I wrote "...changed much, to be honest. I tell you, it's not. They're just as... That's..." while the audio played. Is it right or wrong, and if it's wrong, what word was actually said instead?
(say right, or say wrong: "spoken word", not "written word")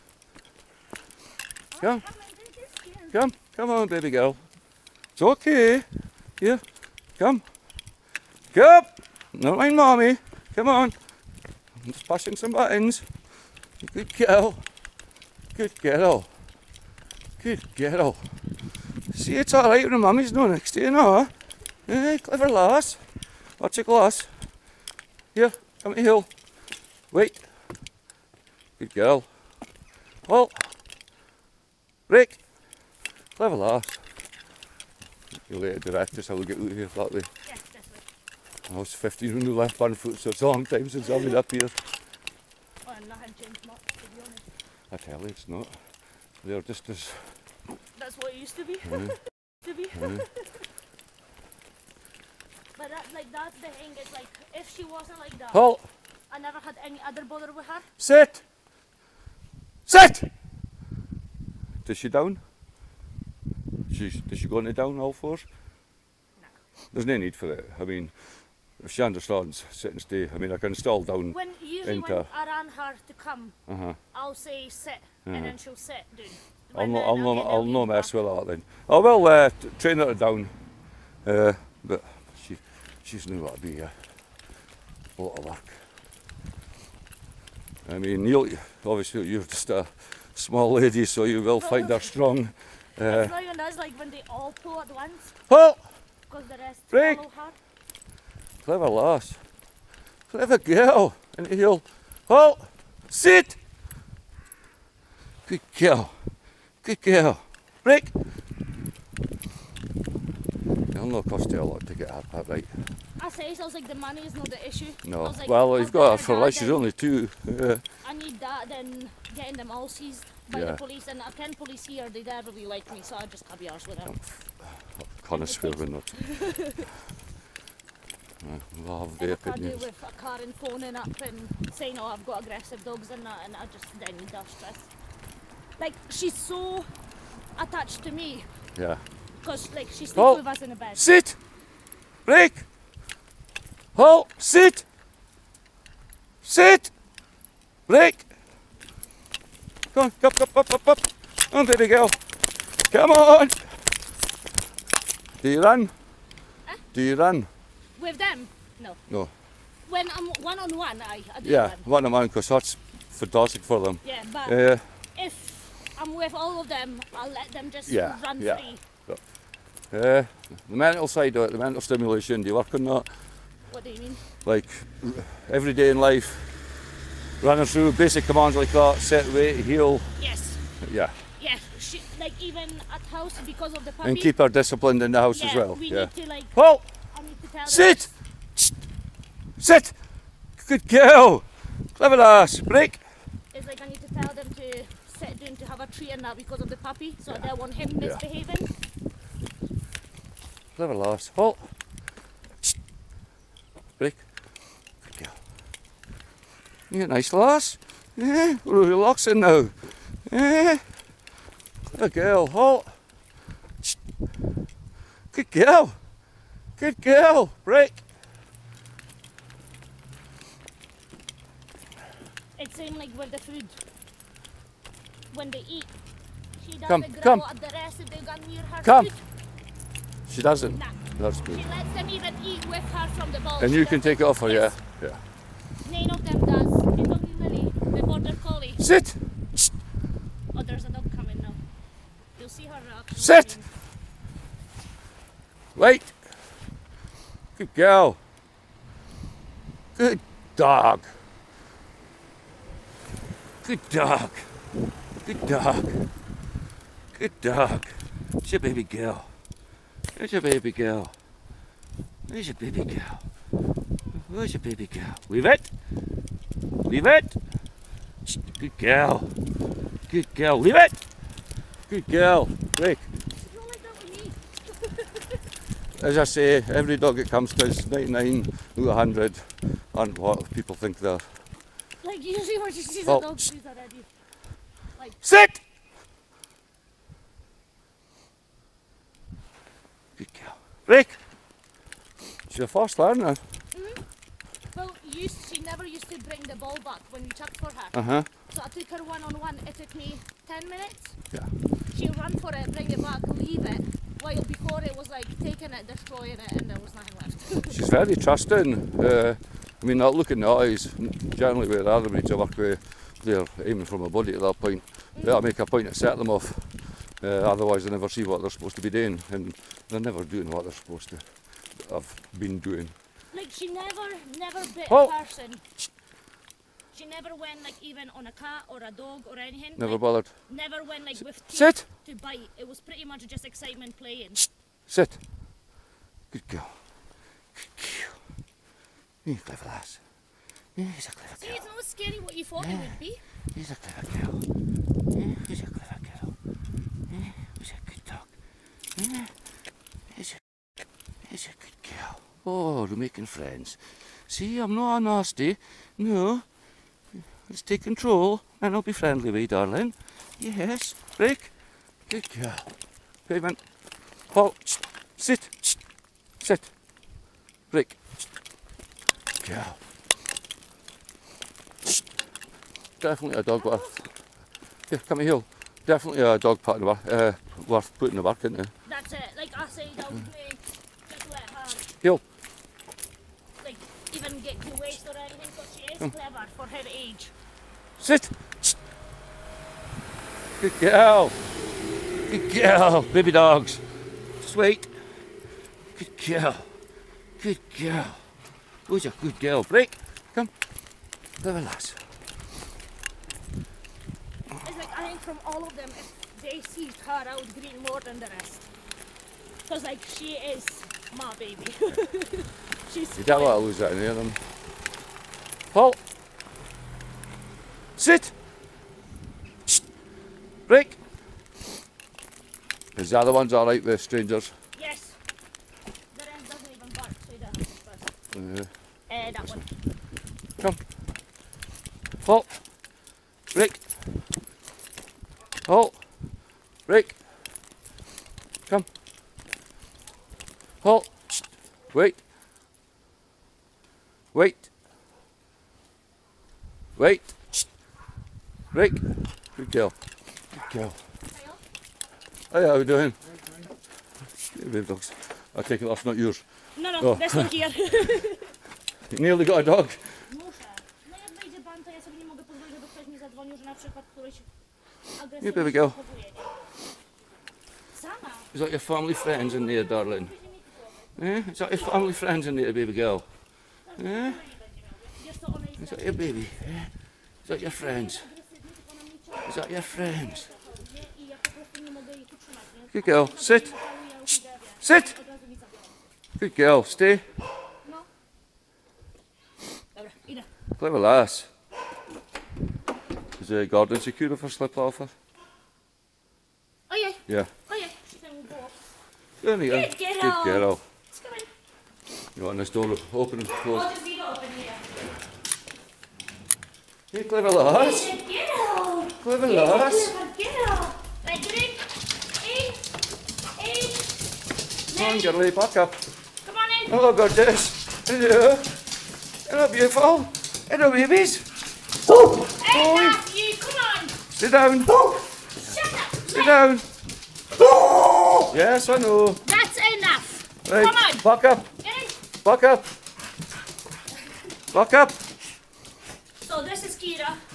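right.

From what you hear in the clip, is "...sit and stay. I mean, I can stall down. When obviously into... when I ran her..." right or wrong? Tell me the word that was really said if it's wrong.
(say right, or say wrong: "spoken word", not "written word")
wrong: "usually", not "obviously".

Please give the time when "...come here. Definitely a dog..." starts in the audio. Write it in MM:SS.
06:15.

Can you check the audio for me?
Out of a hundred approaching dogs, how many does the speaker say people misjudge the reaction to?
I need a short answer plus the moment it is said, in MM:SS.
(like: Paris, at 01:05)
99 out of 100, at 04:37.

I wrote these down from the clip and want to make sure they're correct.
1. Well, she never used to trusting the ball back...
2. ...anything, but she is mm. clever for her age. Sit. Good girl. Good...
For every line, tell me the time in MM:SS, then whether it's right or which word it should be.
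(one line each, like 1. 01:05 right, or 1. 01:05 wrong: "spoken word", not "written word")
1. 04:54 wrong: "bring", not "trusting"
2. 06:25 right.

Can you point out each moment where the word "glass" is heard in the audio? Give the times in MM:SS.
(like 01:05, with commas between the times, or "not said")
00:23.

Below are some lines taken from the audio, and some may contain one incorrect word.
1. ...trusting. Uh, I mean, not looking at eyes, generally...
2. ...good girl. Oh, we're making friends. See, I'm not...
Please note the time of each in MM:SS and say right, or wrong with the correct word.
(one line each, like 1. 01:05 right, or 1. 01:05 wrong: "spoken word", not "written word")
1. 05:08 right
2. 05:51 right.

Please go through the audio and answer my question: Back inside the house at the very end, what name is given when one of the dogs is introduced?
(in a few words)
Kira.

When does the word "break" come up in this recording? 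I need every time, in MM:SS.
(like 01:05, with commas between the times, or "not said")
01:36, 01:47, 03:12, 03:37, 06:01, 06:07, 06:39, 07:00.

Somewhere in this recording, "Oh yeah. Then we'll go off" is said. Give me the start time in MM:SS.
08:17.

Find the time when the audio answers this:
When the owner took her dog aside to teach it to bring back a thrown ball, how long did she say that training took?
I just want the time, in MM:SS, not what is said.
05:00.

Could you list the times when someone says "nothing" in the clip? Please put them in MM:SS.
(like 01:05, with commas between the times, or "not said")
00:43, 05:06.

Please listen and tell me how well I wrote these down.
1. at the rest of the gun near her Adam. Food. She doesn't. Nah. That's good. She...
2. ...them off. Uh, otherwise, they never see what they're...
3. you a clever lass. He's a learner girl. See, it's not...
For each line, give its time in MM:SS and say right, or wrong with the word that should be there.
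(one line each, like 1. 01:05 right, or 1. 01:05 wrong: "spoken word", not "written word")
1. 03:47 wrong: "Come", not "Adam"
2. 05:16 right
3. 05:39 wrong: "clever", not "learner".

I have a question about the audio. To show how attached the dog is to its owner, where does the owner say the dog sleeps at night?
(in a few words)
In the bed.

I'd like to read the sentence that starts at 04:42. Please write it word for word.
Like, usually when she sees oh.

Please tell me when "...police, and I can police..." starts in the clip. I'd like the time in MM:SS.
02:00.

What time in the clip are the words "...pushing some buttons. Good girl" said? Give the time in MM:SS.
00:12.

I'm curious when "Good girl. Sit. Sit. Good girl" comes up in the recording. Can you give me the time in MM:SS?
08:02.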